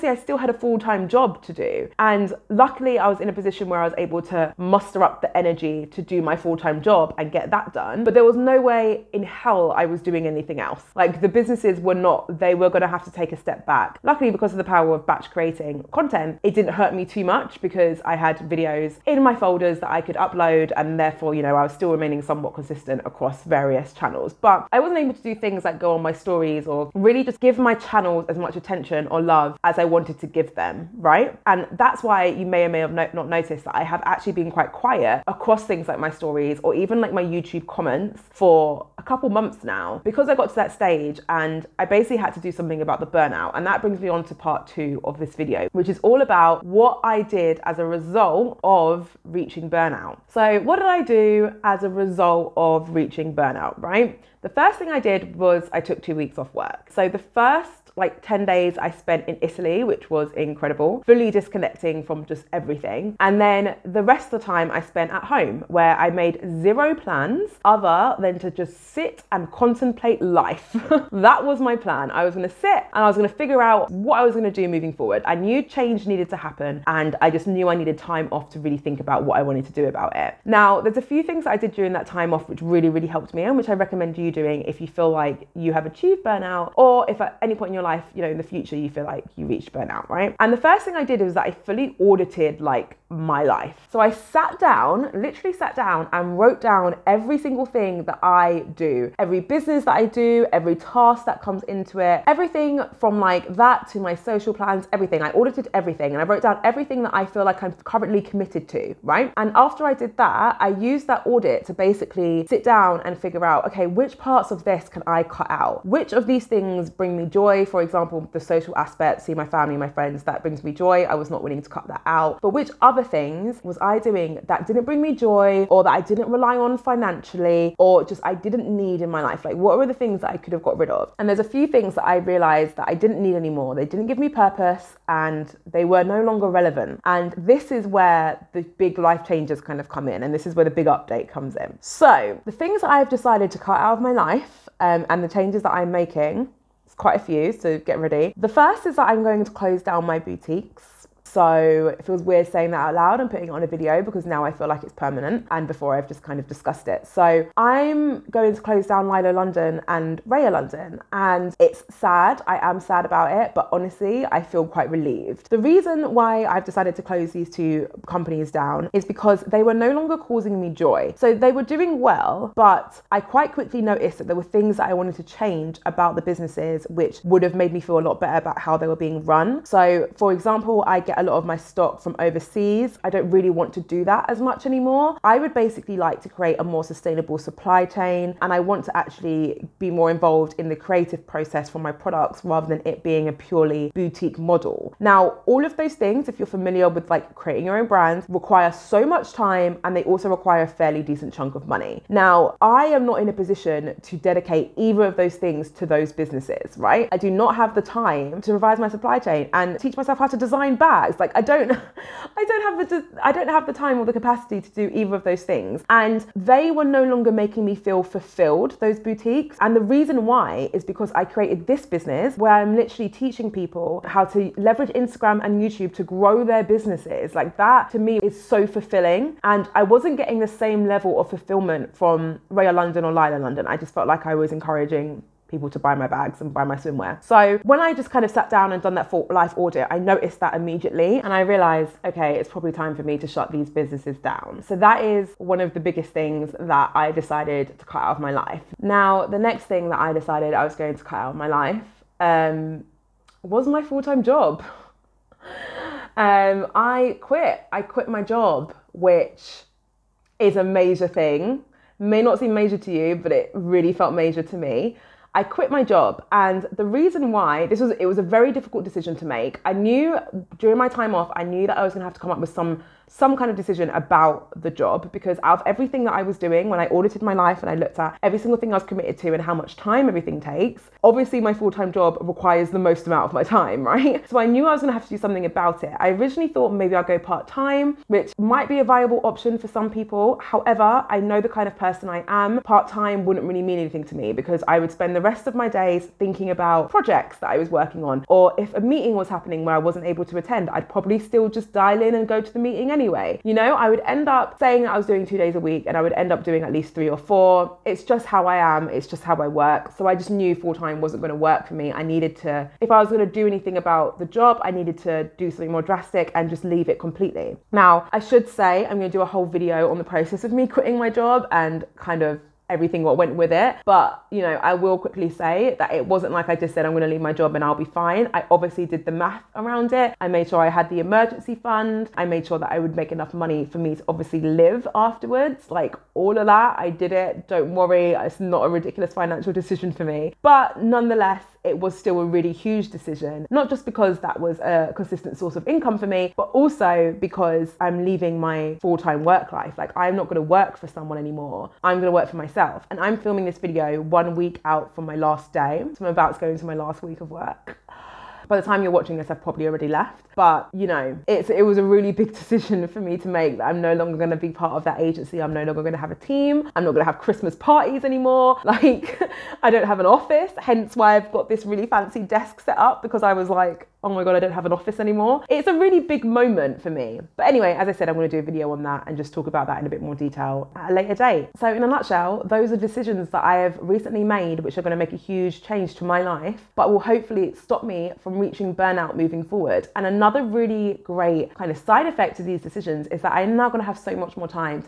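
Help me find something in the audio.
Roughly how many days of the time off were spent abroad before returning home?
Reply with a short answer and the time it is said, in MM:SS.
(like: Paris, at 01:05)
10, at 00:58.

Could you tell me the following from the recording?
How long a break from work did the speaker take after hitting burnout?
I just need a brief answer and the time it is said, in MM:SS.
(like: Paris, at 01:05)
2 weeks, at 00:56.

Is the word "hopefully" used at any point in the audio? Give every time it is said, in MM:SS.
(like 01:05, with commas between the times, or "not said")
06:26.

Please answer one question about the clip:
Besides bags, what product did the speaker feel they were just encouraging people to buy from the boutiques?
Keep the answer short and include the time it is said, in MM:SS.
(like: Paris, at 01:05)
swimwear, at 03:56.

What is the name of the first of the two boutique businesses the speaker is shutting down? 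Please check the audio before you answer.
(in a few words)
Lilo London.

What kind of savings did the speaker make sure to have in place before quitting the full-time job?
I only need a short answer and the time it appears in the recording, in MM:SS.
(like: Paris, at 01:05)
emergency fund, at 05:31.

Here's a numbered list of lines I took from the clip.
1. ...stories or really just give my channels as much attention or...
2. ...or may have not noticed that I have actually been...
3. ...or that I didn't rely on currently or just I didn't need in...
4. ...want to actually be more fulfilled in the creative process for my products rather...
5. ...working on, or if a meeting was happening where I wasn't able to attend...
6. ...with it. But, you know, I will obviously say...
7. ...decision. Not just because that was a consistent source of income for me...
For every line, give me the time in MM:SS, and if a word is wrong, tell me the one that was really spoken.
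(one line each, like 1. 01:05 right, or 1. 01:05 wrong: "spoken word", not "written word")
1. 00:26 right
2. 00:32 right
3. 02:05 wrong: "financially", not "currently"
4. 03:08 wrong: "involved", not "fulfilled"
5. 04:57 right
6. 05:23 wrong: "quickly", not "obviously"
7. 05:42 right.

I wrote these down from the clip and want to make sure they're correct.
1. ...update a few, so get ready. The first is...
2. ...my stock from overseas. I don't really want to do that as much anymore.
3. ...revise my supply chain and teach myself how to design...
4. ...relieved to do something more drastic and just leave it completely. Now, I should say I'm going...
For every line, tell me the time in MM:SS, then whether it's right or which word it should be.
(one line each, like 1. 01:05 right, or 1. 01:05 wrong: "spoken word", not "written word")
1. 02:26 wrong: "quite", not "update"
2. 03:01 right
3. 03:28 right
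4. 05:14 wrong: "needed", not "relieved".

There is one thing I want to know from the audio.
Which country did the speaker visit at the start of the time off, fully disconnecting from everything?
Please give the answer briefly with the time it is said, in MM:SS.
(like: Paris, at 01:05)
Italy, at 00:59.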